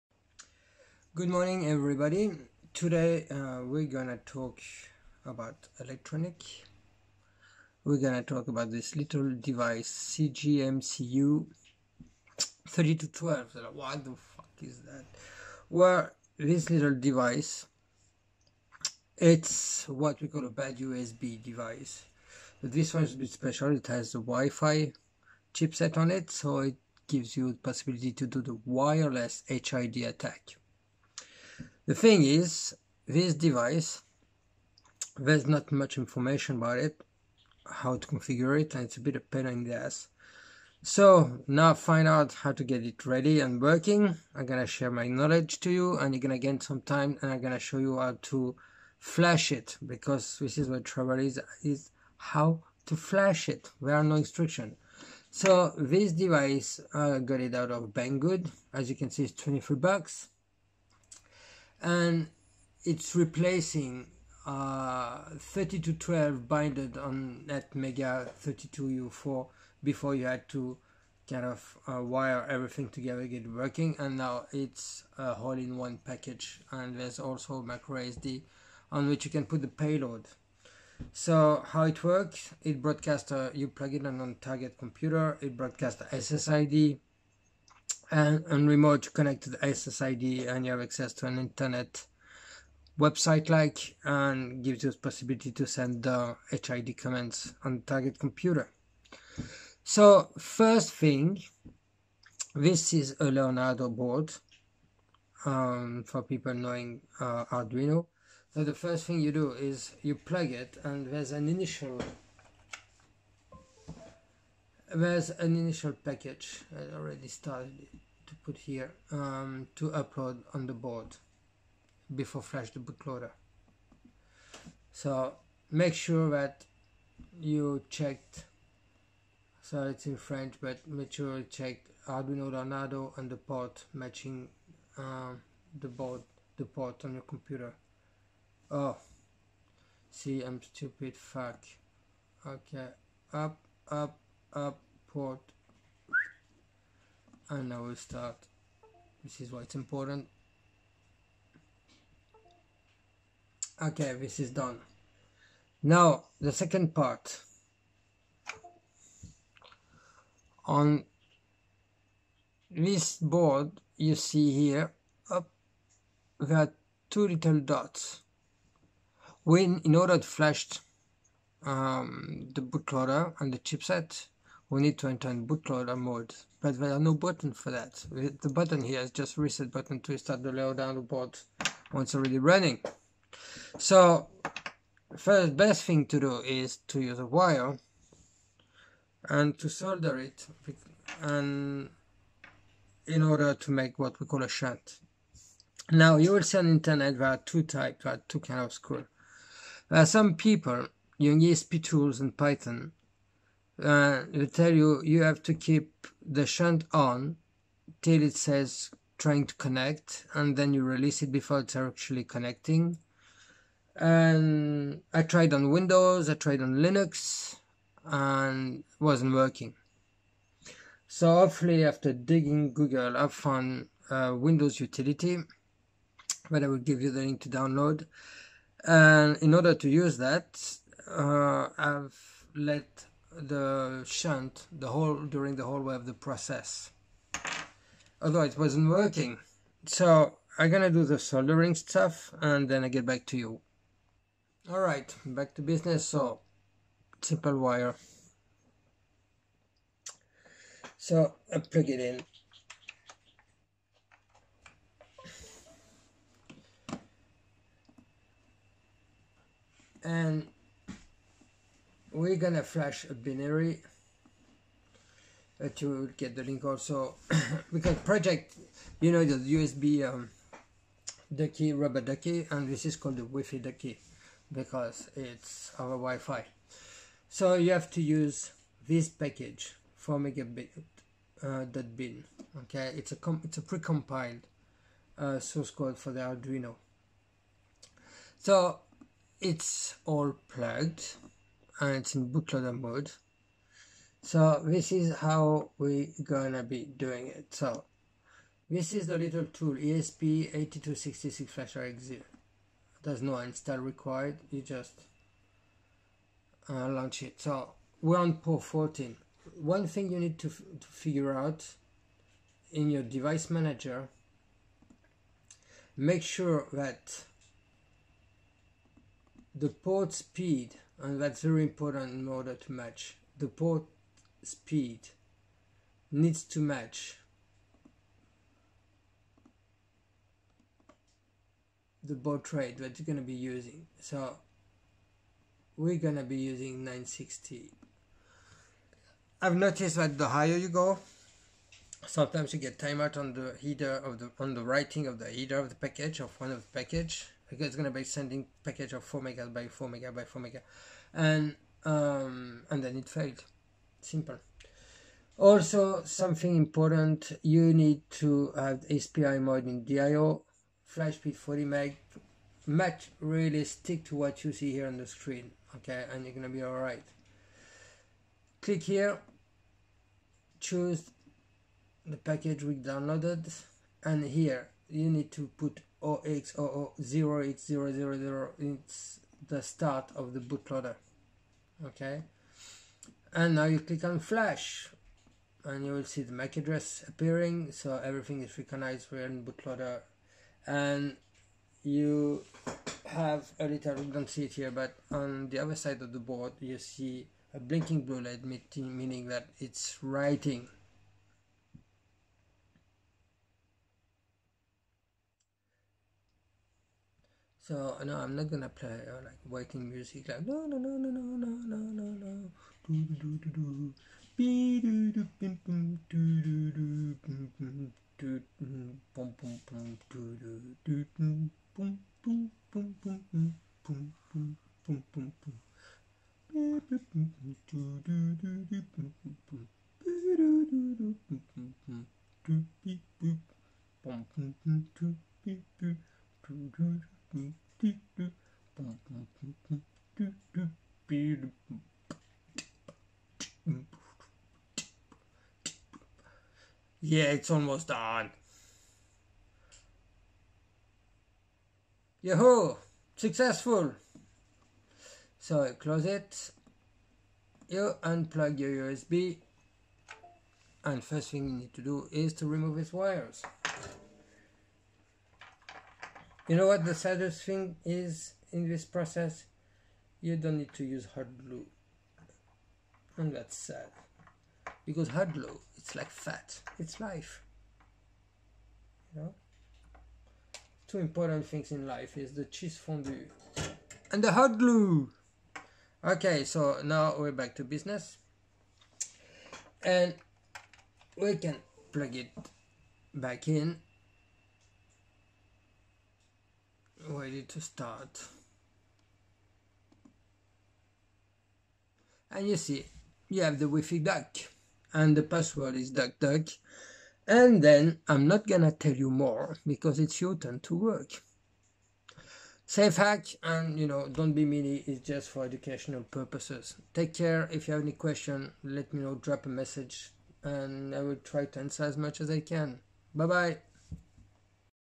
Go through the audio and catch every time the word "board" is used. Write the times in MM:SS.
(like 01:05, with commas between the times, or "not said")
01:43, 02:00, 02:15, 02:43, 06:36.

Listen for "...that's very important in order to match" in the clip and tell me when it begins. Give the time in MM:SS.
05:21.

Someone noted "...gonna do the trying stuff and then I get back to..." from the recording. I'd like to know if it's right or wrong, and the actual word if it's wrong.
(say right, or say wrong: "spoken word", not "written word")
wrong: "soldering", not "trying".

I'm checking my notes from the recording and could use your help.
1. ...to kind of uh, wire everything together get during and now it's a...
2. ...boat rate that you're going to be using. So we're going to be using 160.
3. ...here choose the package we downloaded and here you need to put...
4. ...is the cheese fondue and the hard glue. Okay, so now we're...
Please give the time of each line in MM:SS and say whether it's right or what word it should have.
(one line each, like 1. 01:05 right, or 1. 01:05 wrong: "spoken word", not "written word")
1. 01:10 wrong: "working", not "during"
2. 05:32 wrong: "960", not "160"
3. 06:08 right
4. 08:02 right.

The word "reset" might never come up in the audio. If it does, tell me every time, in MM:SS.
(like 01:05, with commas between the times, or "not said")
02:59.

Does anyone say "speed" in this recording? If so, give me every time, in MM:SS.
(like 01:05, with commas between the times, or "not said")
05:20, 05:24, 06:01.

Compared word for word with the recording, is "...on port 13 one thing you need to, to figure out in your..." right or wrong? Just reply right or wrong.
wrong.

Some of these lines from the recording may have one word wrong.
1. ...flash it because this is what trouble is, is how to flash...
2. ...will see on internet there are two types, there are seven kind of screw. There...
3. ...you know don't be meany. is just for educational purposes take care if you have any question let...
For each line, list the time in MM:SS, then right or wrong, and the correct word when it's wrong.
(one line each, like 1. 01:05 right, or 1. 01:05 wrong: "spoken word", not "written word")
1. 00:48 right
2. 03:16 wrong: "two", not "seven"
3. 08:33 right.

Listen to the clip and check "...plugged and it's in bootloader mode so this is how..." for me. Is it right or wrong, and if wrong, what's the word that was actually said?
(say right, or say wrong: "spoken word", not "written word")
right.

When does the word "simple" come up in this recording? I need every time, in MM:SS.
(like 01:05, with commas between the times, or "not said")
04:07, 05:53.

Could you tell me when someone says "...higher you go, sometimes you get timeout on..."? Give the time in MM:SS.
05:40.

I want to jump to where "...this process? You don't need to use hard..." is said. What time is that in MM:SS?
07:48.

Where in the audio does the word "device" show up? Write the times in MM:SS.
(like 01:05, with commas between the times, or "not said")
00:09, 00:16, 00:21, 00:33, 00:56, 05:13.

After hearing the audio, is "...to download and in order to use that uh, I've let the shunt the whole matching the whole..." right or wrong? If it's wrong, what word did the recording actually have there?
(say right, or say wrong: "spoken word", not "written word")
wrong: "during", not "matching".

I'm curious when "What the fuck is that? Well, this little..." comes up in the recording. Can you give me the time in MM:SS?
00:13.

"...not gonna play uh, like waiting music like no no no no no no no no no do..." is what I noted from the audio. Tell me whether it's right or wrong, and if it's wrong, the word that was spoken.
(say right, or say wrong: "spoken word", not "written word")
right.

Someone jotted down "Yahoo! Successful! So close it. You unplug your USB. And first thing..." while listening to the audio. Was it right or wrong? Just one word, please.
right.